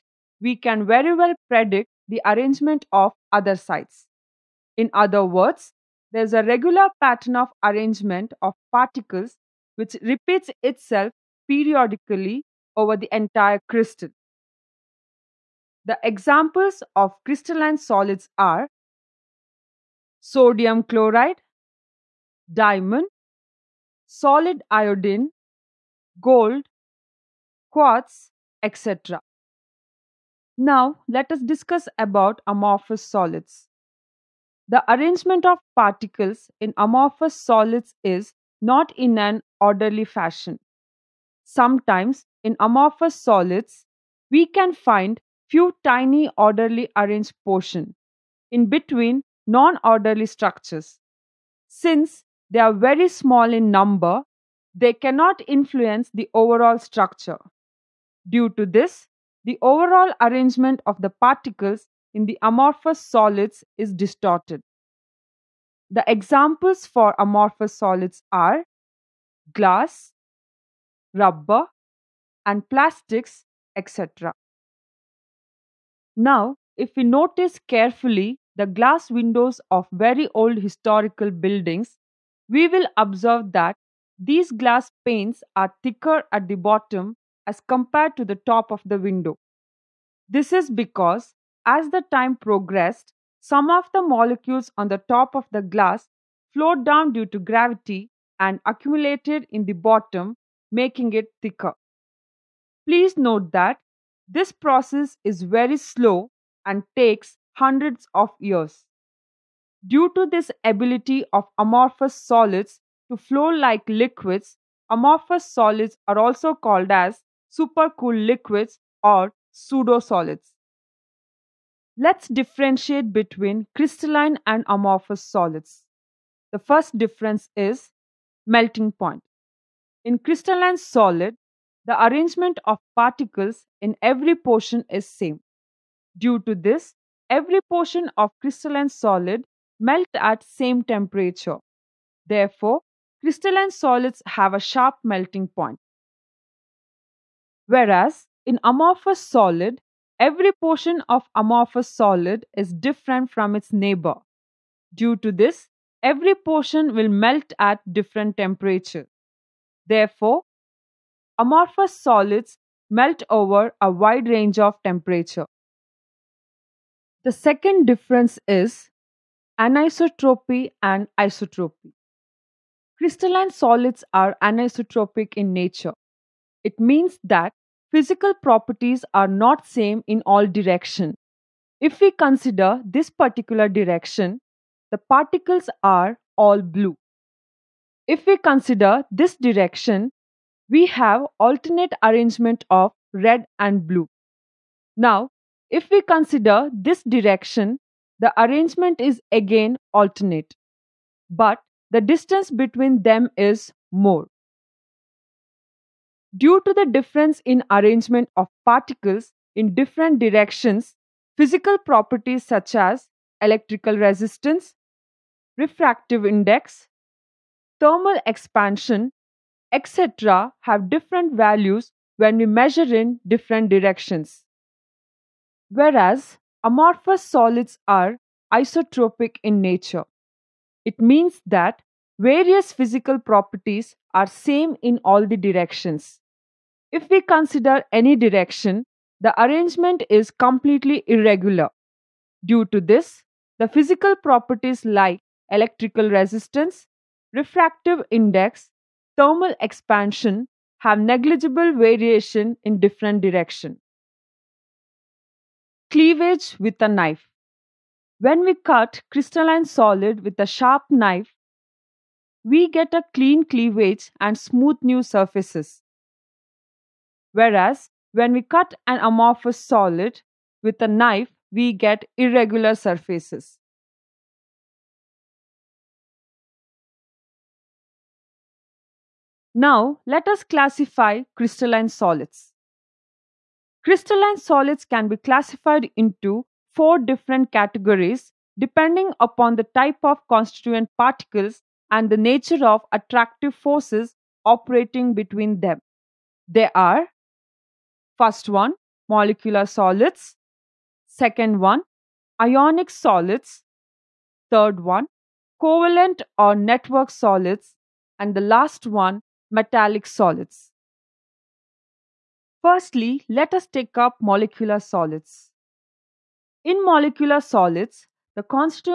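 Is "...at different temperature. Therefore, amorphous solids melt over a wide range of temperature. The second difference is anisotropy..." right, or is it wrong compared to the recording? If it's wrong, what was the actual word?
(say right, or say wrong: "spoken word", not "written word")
right.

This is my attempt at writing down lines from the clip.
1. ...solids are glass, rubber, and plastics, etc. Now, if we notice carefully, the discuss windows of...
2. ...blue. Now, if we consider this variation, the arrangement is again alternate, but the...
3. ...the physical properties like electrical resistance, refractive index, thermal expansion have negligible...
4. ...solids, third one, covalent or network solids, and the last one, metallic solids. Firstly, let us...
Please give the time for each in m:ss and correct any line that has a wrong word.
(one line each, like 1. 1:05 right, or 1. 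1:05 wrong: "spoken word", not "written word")
1. 1:07 wrong: "glass", not "discuss"
2. 3:13 wrong: "direction", not "variation"
3. 4:03 right
4. 5:02 right.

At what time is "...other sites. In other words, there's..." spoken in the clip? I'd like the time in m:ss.
0:03.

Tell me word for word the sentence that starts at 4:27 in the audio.
Whereas when we cut an amorphous solid with a knife, we get irregular surfaces.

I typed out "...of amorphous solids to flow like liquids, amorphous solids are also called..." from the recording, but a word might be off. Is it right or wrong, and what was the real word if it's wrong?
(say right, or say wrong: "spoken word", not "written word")
right.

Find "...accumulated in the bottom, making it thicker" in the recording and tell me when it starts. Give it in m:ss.
1:38.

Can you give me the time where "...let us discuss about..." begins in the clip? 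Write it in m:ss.
0:31.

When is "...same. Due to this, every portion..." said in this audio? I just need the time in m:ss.
2:15.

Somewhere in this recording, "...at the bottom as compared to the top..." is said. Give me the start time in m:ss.
1:26.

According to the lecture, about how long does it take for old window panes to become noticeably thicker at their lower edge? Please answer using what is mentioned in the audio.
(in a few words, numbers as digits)
hundreds of years.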